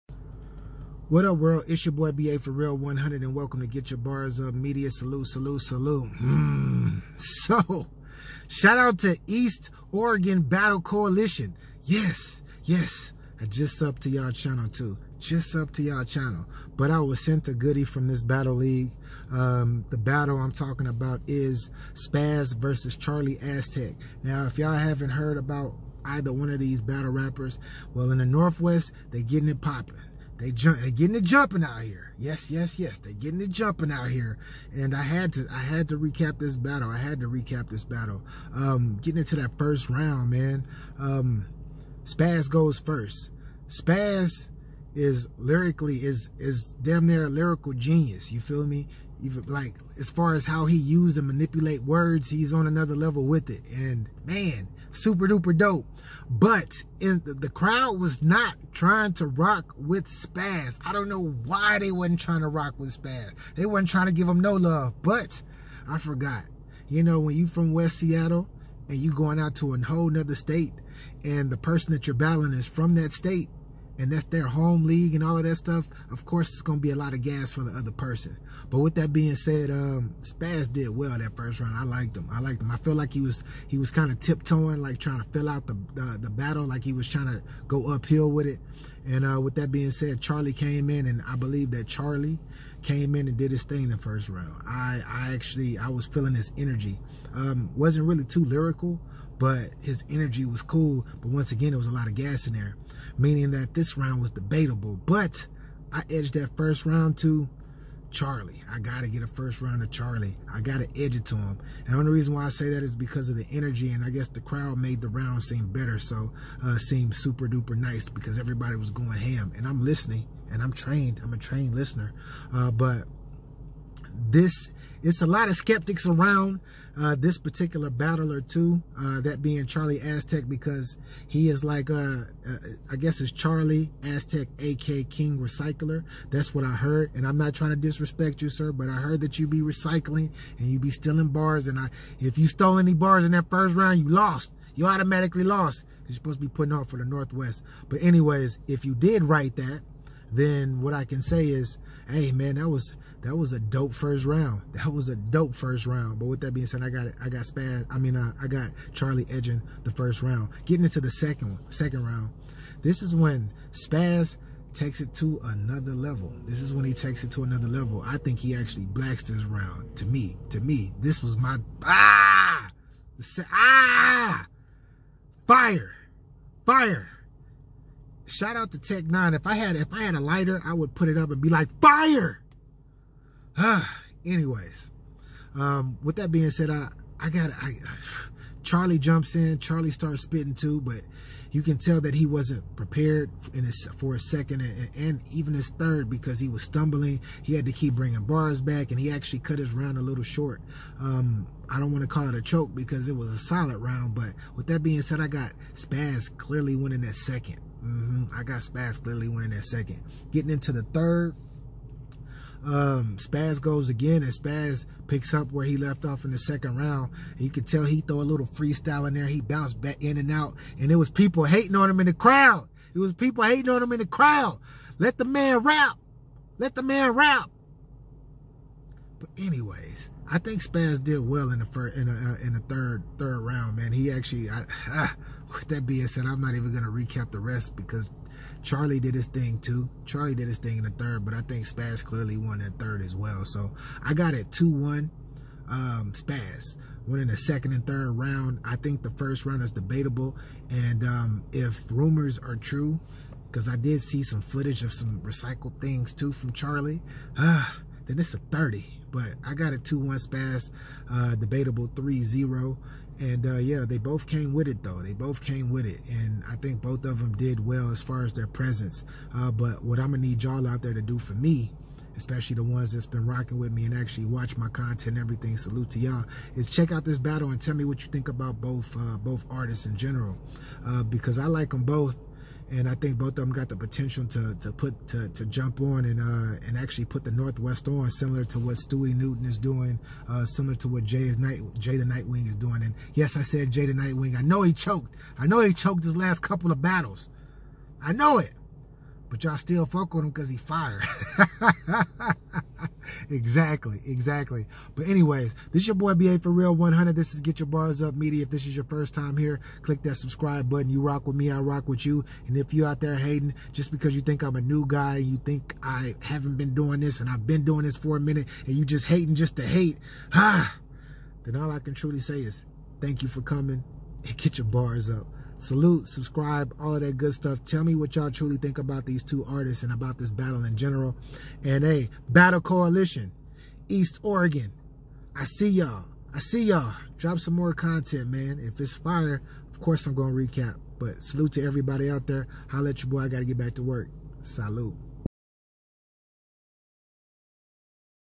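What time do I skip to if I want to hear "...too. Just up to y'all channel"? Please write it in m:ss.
0:14.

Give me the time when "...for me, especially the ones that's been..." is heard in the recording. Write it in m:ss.
4:31.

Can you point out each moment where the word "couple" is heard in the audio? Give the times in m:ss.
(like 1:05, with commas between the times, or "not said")
4:56.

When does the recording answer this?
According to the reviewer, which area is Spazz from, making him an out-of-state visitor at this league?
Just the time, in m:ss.
1:07.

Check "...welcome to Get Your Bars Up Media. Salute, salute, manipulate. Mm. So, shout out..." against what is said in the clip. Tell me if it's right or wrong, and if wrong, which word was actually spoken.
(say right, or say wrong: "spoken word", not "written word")
wrong: "salute", not "manipulate".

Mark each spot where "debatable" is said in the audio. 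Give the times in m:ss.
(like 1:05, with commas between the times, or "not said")
1:44, 4:09, 4:21.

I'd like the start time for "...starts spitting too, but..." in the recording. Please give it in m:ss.
3:09.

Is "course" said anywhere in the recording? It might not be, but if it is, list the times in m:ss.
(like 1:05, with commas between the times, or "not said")
1:16, 5:39.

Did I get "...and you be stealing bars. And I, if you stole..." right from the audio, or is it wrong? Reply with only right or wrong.
right.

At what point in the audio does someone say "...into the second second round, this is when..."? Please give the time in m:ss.
2:40.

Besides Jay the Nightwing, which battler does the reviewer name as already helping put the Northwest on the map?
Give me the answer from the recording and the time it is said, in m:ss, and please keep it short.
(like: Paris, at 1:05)
Stewie Newton, at 4:48.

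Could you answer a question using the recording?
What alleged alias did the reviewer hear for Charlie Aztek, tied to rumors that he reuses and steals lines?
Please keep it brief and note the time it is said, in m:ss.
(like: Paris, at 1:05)
King Recycler, at 2:15.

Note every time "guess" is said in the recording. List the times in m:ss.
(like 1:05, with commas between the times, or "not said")
1:54, 2:12.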